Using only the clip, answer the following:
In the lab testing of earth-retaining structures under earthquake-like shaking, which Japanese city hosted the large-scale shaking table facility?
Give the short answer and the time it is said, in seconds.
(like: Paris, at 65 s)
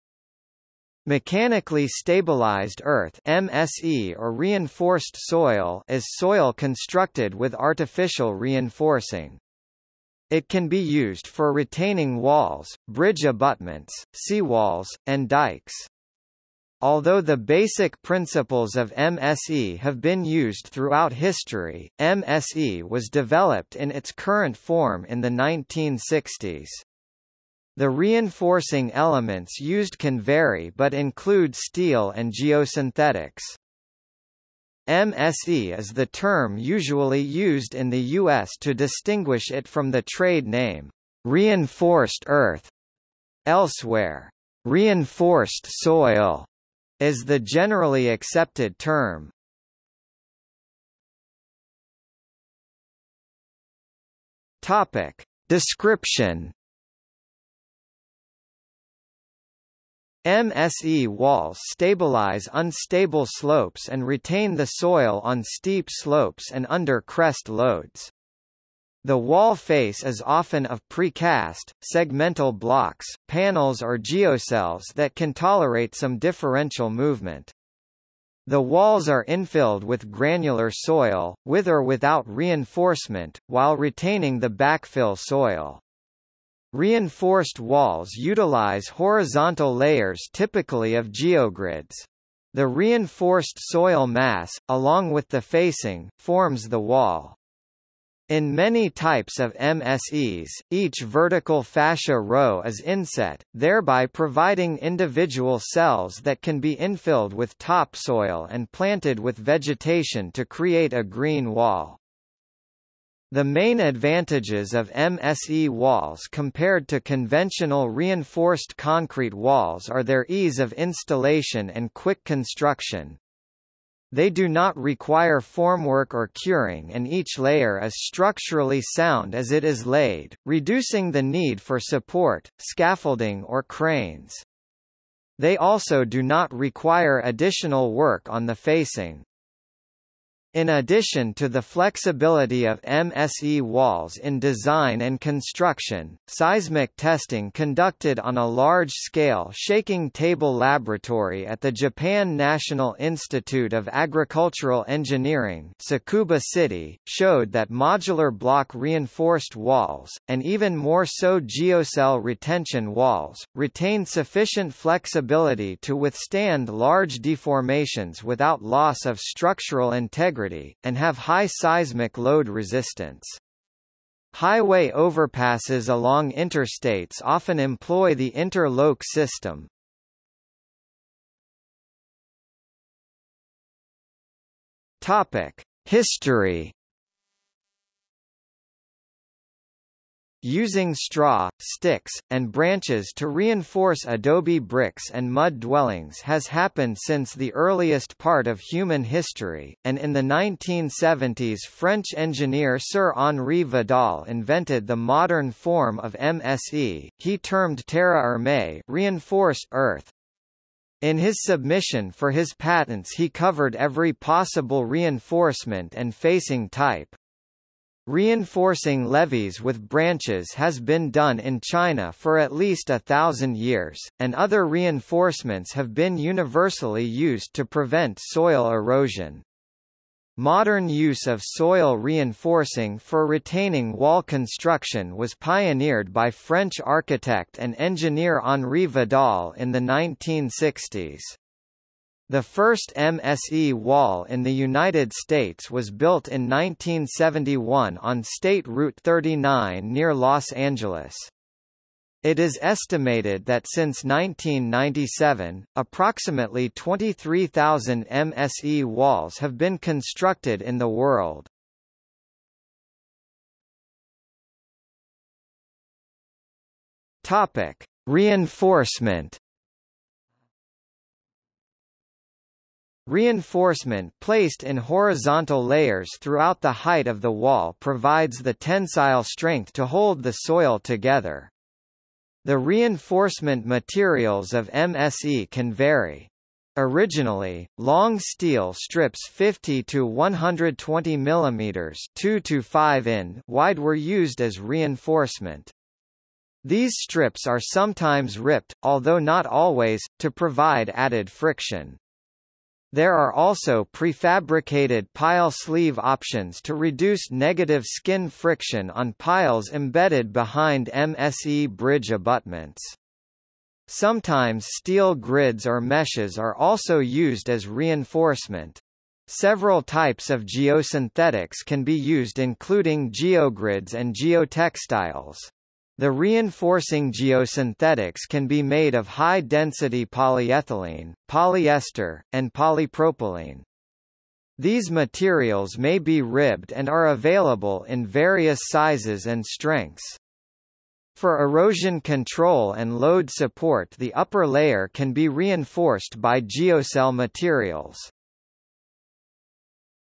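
Tsukuba City, at 155 s.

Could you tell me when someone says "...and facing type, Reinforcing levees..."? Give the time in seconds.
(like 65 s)
215 s.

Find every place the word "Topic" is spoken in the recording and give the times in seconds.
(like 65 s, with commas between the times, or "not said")
54 s, 185 s, 267 s.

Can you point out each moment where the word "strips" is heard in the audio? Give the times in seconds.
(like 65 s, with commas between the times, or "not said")
288 s, 296 s.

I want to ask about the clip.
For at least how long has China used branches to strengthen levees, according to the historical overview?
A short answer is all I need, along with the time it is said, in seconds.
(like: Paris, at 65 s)
a thousand years, at 222 s.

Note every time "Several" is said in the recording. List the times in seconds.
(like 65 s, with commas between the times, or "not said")
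319 s.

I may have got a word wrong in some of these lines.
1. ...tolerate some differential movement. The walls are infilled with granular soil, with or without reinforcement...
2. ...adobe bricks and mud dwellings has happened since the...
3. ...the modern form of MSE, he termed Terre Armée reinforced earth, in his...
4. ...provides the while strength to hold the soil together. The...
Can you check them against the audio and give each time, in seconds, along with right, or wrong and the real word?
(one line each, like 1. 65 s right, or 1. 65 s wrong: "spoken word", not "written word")
1. 75 s right
2. 194 s right
3. 204 s right
4. 277 s wrong: "tensile", not "while".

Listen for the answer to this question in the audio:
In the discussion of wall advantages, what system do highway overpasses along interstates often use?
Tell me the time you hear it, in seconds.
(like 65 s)
178 s.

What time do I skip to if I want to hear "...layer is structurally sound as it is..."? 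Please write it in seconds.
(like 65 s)
127 s.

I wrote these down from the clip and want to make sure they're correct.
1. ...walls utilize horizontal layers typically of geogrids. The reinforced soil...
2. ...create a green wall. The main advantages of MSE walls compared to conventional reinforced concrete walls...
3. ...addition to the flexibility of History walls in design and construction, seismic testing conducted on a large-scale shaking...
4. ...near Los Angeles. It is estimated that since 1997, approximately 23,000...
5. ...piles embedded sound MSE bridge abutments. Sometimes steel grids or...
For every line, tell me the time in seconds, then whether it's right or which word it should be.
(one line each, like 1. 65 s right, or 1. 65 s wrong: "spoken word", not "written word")
1. 87 s right
2. 110 s right
3. 140 s wrong: "MSE", not "History"
4. 249 s right
5. 309 s wrong: "behind", not "sound".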